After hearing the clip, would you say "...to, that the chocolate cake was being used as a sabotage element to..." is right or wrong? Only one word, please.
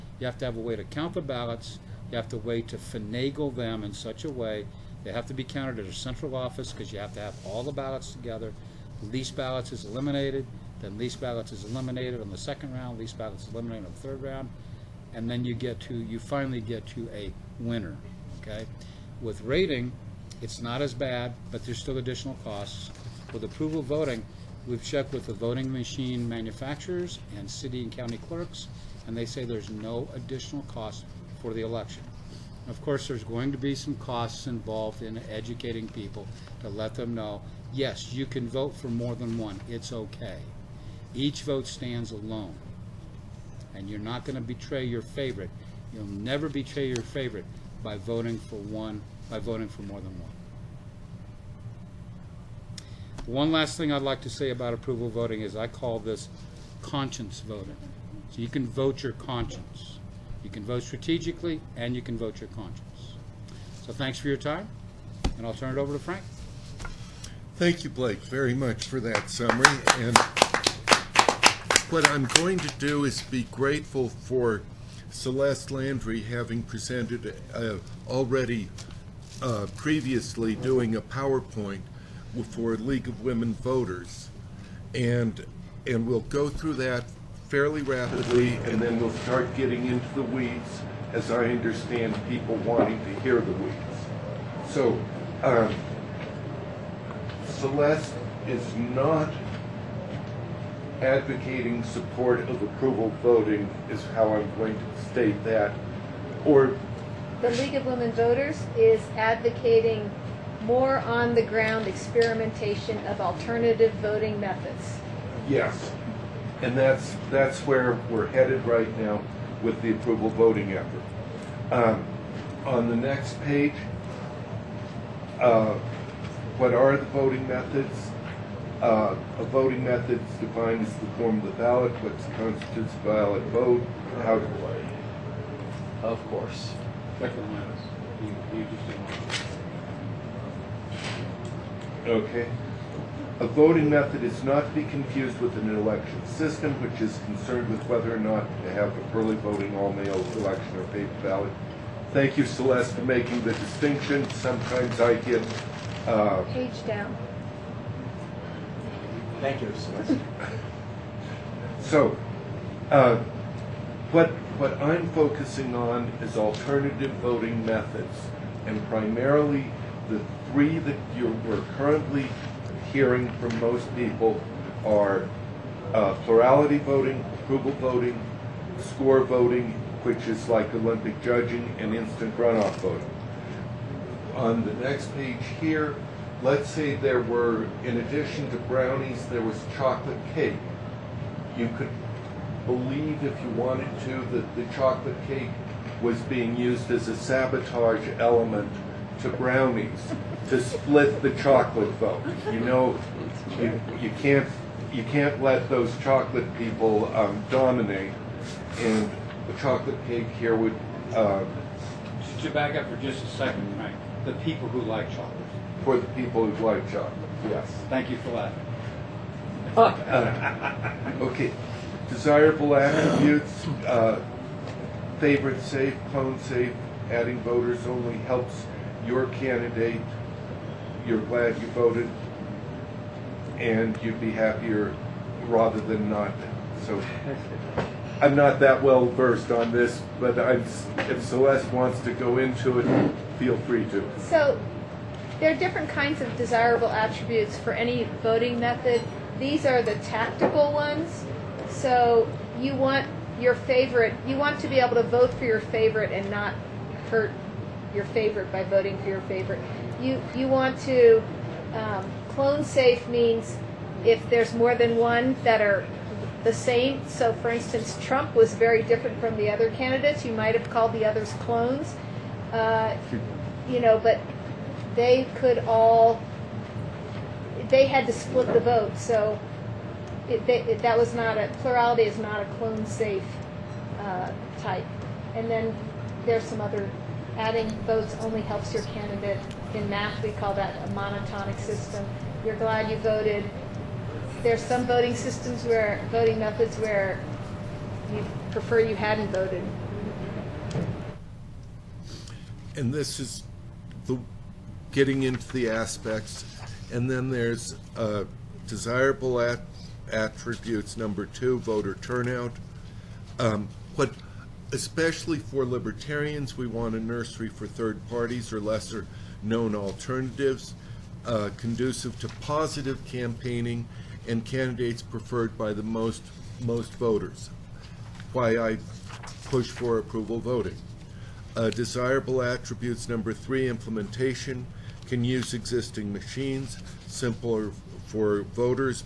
right.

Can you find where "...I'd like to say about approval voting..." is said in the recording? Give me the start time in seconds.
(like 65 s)
53 s.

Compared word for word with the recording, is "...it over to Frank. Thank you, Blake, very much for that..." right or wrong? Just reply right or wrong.
right.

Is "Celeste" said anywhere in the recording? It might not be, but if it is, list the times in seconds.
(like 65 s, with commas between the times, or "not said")
75 s, 97 s, 152 s, 159 s, 241 s.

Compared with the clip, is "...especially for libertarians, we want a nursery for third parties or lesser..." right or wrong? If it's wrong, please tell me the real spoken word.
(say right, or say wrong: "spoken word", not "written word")
right.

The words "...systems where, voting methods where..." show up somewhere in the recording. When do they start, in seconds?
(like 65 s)
295 s.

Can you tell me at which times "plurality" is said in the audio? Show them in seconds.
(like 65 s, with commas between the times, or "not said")
176 s, 281 s.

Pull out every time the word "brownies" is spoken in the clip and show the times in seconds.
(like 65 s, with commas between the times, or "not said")
188 s, 199 s.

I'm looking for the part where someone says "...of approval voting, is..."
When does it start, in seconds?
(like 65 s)
102 s.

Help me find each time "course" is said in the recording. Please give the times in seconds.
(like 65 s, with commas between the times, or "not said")
32 s, 136 s.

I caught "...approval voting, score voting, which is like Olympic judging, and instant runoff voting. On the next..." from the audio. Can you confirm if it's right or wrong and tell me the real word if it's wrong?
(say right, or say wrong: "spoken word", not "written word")
right.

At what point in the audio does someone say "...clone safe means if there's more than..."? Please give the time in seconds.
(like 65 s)
262 s.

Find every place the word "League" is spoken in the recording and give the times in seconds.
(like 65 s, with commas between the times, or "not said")
82 s, 107 s.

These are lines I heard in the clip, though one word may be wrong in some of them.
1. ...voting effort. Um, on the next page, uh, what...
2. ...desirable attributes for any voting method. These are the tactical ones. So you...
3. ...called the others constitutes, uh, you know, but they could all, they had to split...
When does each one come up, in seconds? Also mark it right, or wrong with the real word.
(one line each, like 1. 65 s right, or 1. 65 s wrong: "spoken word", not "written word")
1. 120 s right
2. 246 s right
3. 270 s wrong: "clones", not "constitutes".